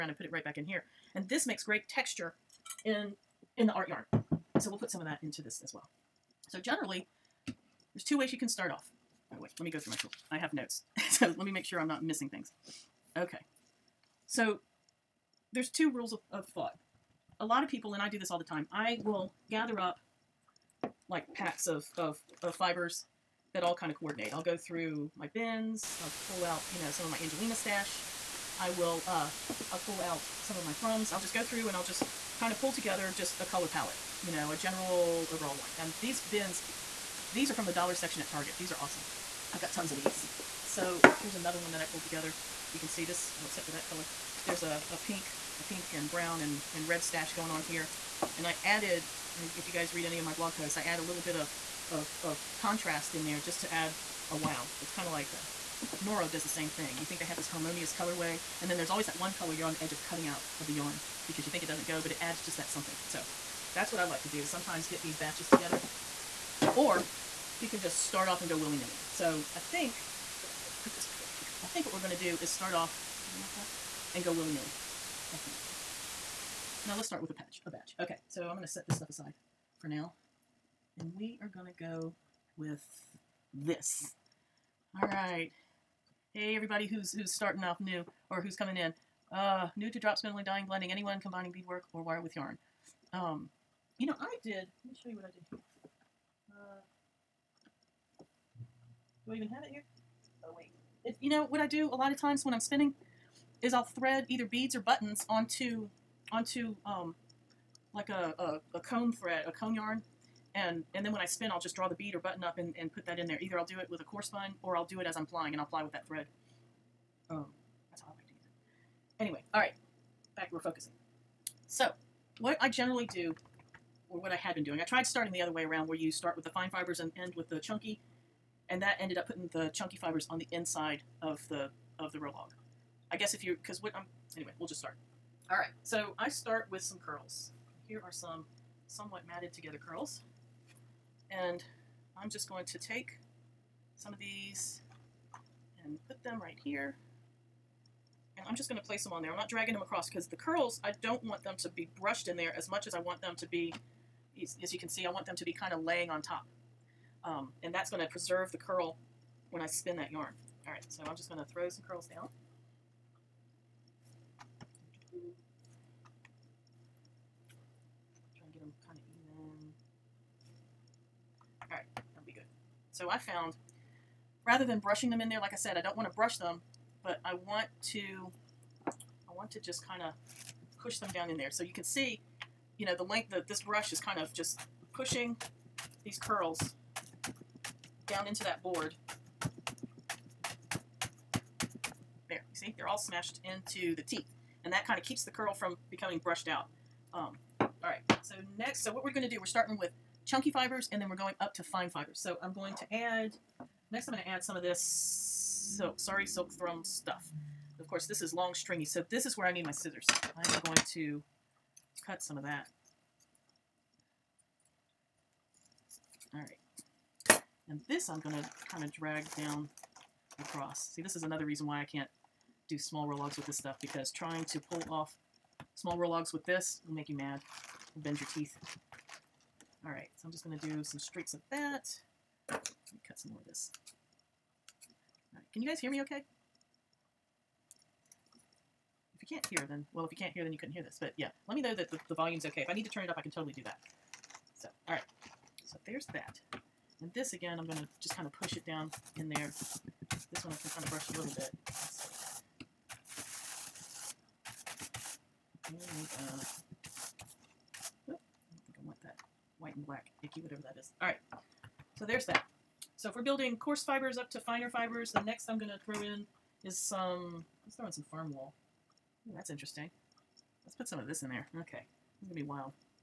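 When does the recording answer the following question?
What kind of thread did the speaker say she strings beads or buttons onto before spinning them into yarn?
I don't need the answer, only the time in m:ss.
1:48.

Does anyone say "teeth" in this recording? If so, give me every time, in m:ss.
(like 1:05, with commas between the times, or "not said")
3:14, 3:48.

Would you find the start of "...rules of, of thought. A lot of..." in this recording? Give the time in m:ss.
0:15.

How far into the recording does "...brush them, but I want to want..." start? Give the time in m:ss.
2:56.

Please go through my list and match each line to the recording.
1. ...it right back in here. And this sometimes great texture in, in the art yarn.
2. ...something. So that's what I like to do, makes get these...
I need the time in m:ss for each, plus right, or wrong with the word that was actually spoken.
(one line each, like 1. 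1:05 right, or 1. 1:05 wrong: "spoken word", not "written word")
1. 0:00 wrong: "makes", not "sometimes"
2. 1:02 wrong: "sometimes", not "makes".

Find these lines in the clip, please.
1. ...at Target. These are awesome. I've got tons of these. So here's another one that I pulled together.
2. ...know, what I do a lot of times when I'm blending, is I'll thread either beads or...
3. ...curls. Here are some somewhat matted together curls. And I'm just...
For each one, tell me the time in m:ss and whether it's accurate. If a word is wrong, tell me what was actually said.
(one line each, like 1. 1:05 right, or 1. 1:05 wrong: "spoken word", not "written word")
1. 0:38 right
2. 1:41 wrong: "spinning", not "blending"
3. 2:17 right.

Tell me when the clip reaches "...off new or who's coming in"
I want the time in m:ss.
1:27.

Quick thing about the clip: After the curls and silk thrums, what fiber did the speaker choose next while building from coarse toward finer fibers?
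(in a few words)
Farm wool.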